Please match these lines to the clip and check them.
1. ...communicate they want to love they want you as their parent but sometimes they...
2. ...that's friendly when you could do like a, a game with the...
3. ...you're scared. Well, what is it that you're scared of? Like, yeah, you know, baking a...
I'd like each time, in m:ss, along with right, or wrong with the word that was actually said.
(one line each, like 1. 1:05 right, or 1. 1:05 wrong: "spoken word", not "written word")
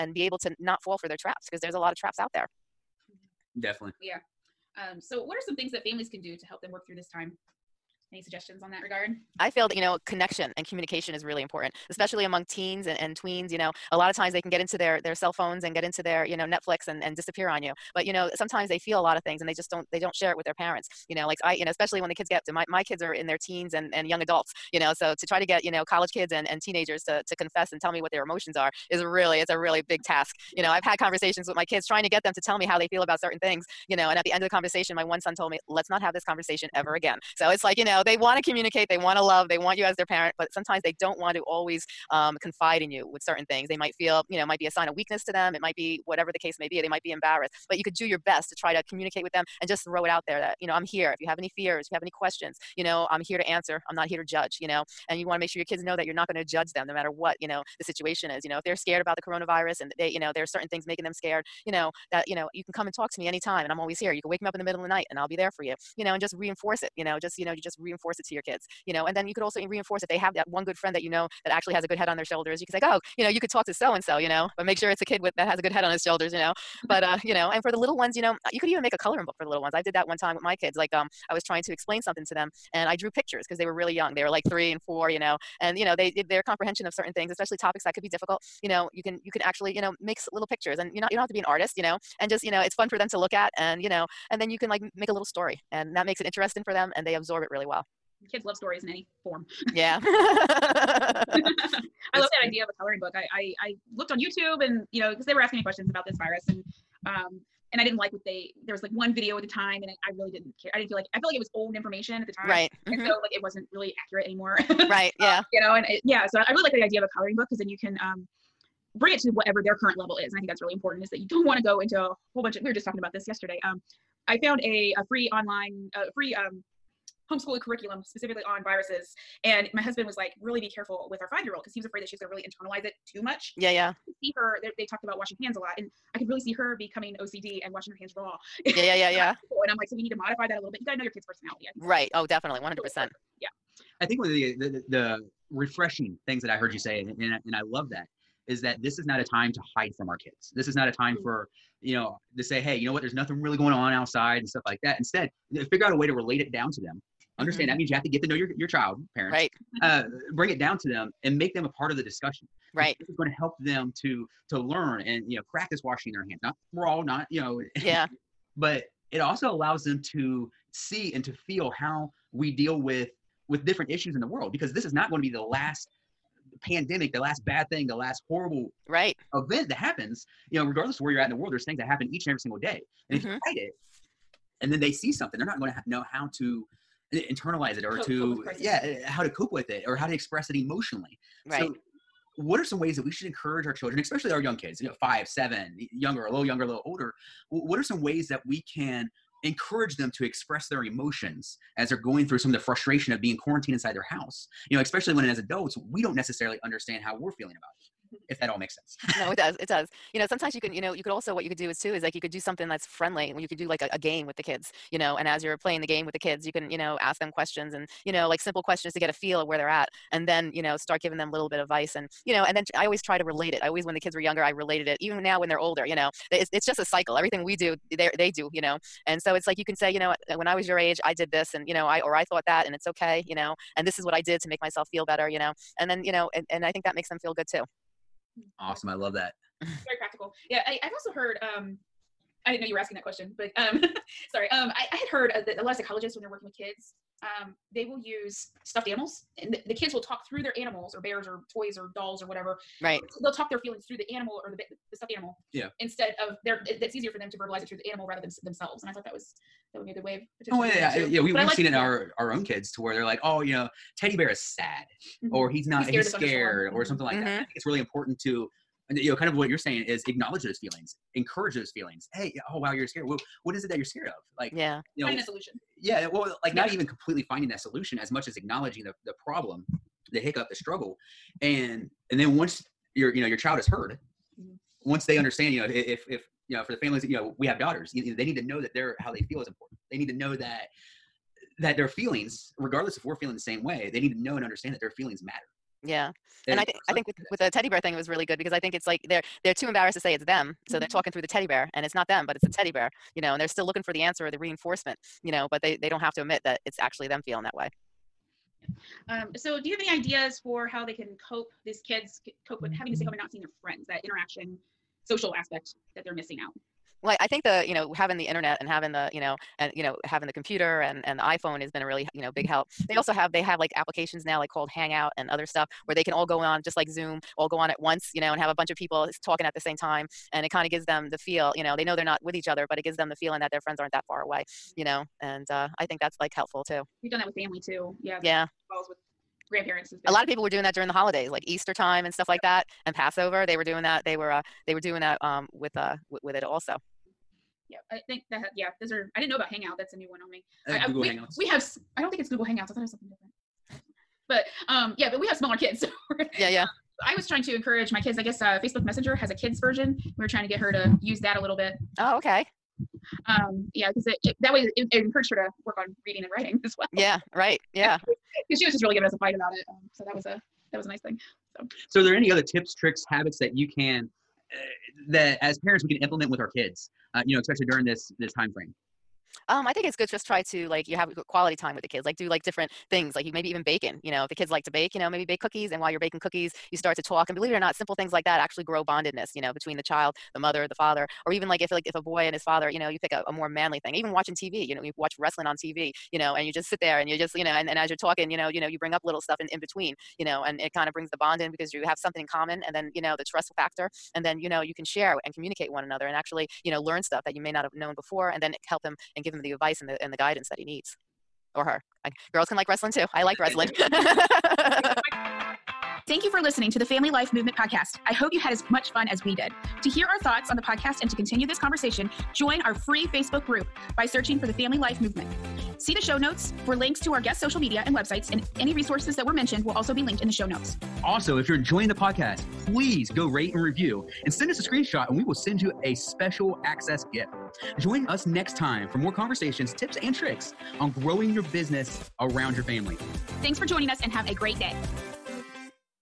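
1. 0:38 right
2. 3:32 right
3. 4:32 wrong: "finding", not "baking".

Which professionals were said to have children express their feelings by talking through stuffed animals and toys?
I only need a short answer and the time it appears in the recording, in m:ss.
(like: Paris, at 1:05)
Psychologists, at 4:05.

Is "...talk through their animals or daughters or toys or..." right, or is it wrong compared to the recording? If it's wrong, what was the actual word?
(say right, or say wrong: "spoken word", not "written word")
wrong: "bears", not "daughters".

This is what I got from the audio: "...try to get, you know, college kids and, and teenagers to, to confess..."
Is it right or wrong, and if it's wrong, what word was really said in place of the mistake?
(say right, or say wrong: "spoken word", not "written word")
right.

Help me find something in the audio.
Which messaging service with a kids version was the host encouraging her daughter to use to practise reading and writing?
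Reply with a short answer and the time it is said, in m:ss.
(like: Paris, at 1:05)
Facebook Messenger, at 5:58.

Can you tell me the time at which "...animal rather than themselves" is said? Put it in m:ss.
4:17.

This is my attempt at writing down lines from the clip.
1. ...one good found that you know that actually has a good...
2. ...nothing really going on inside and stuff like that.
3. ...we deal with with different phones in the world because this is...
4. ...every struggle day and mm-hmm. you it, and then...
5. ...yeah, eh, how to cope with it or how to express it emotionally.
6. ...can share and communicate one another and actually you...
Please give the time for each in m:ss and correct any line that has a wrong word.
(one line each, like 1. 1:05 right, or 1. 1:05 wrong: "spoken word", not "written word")
1. 1:10 wrong: "friend", not "found"
2. 2:33 wrong: "outside", not "inside"
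3. 2:52 wrong: "issues", not "phones"
4. 3:02 wrong: "single", not "struggle"
5. 3:08 right
6. 6:44 right.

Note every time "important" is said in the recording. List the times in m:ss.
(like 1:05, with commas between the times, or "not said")
0:11, 2:00, 4:27, 4:49.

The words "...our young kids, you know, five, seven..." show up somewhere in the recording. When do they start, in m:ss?
3:14.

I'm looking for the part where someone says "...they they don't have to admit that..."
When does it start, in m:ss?
5:05.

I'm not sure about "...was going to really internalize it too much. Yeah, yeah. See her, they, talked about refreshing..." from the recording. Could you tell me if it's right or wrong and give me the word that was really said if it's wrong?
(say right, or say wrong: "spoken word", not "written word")
wrong: "washing", not "refreshing".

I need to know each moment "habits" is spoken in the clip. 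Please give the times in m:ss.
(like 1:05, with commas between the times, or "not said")
6:13.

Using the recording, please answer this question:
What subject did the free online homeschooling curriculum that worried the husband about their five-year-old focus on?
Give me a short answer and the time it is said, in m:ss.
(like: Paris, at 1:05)
Viruses, at 2:08.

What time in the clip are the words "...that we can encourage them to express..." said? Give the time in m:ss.
3:18.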